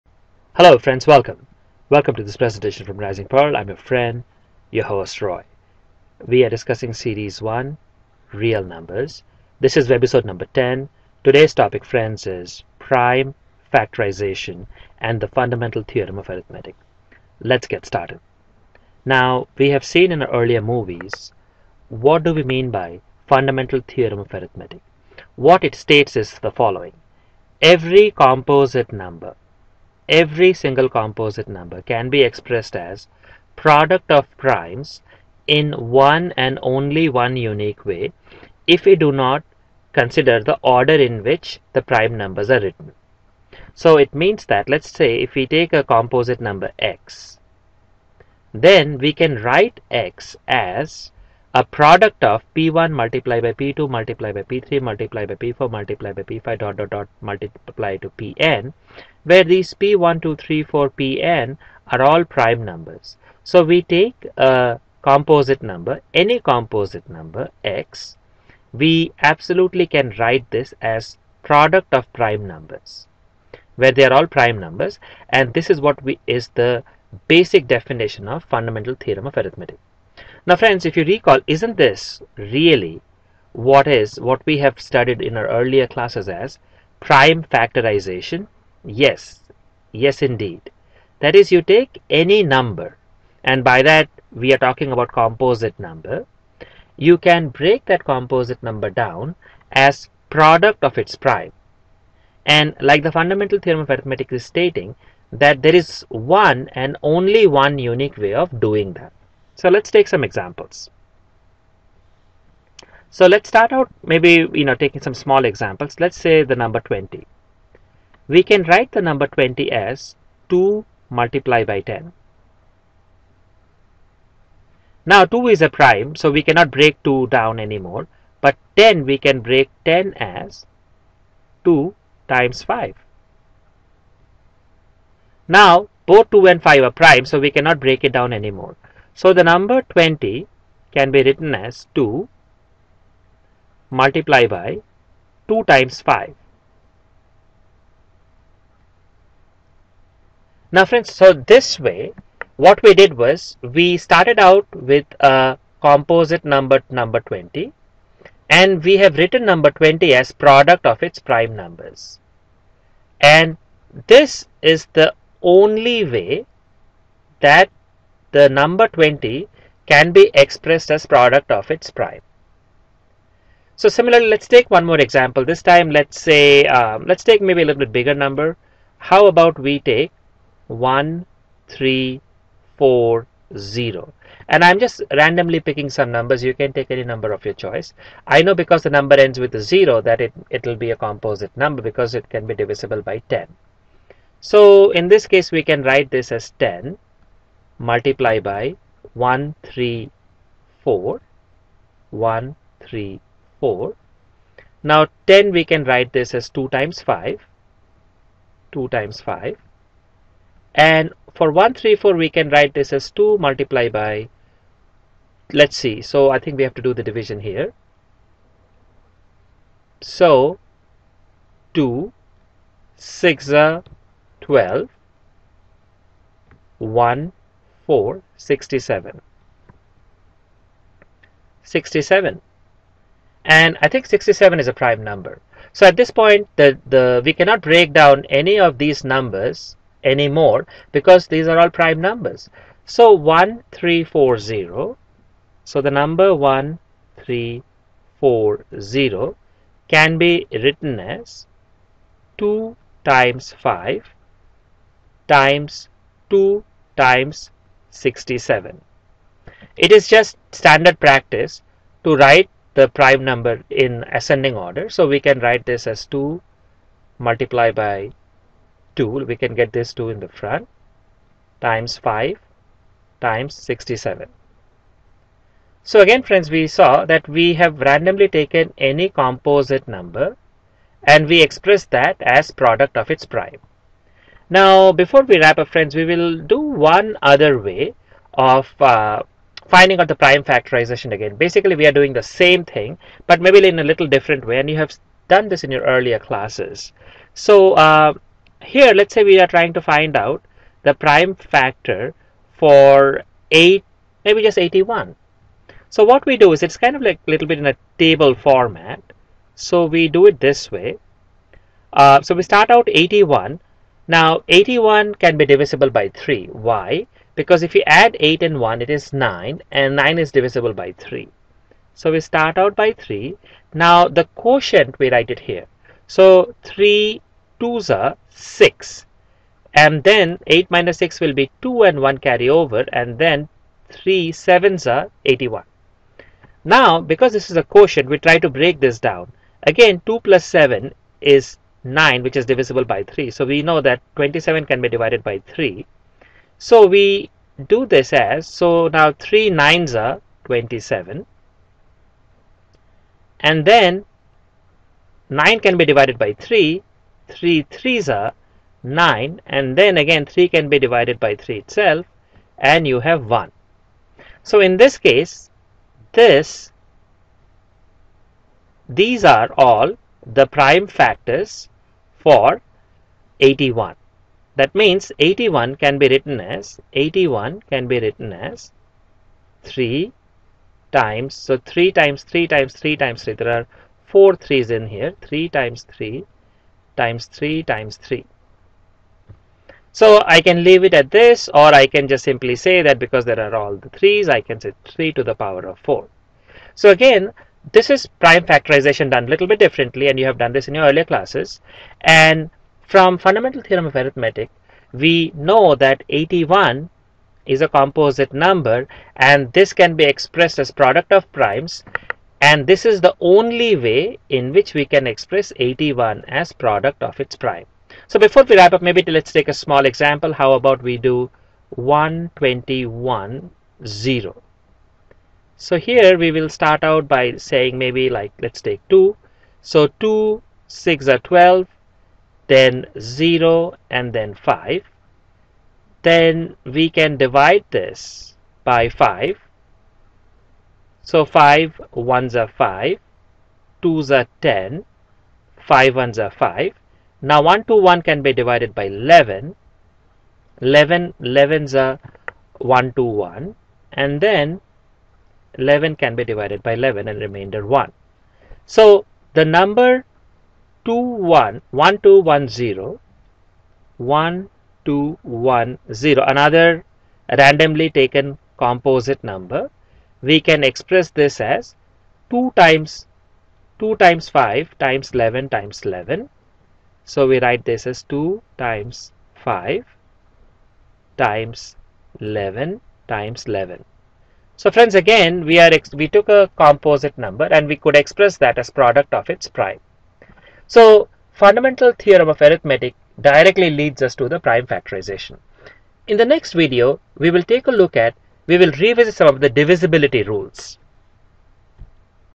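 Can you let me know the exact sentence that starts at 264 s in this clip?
So we can write this as 2 multiplied by 2.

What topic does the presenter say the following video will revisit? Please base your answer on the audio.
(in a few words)
divisibility rules.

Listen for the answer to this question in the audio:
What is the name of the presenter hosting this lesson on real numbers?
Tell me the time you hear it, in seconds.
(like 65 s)
5 s.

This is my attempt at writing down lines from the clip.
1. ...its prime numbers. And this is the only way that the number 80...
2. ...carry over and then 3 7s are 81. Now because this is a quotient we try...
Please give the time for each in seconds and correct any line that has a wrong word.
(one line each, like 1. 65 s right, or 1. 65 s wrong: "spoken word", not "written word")
1. 161 s wrong: "20", not "80"
2. 332 s right.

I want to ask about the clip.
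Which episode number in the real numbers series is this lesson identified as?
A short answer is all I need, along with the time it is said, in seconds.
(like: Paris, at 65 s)
10, at 9 s.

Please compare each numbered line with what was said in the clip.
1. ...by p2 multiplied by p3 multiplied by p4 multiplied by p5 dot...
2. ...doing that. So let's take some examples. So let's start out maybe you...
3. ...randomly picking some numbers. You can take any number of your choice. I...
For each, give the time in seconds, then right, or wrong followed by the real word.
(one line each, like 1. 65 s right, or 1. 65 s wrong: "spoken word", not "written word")
1. 53 s right
2. 108 s right
3. 185 s right.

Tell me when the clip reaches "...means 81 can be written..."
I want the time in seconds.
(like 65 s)
374 s.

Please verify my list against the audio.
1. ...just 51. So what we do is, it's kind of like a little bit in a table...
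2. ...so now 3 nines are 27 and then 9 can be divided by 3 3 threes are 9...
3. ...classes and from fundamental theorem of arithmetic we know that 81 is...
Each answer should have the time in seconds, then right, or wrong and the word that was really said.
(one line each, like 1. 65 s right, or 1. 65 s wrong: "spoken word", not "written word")
1. 304 s wrong: "81", not "51"
2. 348 s right
3. 401 s right.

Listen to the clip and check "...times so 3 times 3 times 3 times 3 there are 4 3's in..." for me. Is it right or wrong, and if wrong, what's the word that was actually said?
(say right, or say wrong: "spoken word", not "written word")
right.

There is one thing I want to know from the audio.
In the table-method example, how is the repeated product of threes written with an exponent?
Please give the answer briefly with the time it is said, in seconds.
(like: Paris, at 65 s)
3 to the power of 4, at 394 s.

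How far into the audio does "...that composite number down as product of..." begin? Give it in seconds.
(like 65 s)
97 s.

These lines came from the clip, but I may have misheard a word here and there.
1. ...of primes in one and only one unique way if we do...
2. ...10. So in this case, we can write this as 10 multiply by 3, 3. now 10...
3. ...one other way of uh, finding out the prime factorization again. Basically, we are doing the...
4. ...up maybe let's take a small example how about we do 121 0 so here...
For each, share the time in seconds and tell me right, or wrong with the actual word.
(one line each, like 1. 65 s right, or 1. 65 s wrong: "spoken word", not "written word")
1. 34 s right
2. 193 s wrong: "4", not "3"
3. 286 s right
4. 418 s right.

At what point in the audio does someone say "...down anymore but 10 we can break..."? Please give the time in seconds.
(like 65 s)
127 s.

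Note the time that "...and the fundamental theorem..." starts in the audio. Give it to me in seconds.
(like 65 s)
14 s.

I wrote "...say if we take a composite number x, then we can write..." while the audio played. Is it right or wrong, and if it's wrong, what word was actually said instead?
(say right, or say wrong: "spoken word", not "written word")
right.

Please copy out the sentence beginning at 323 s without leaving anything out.
Now the quotient we write it here.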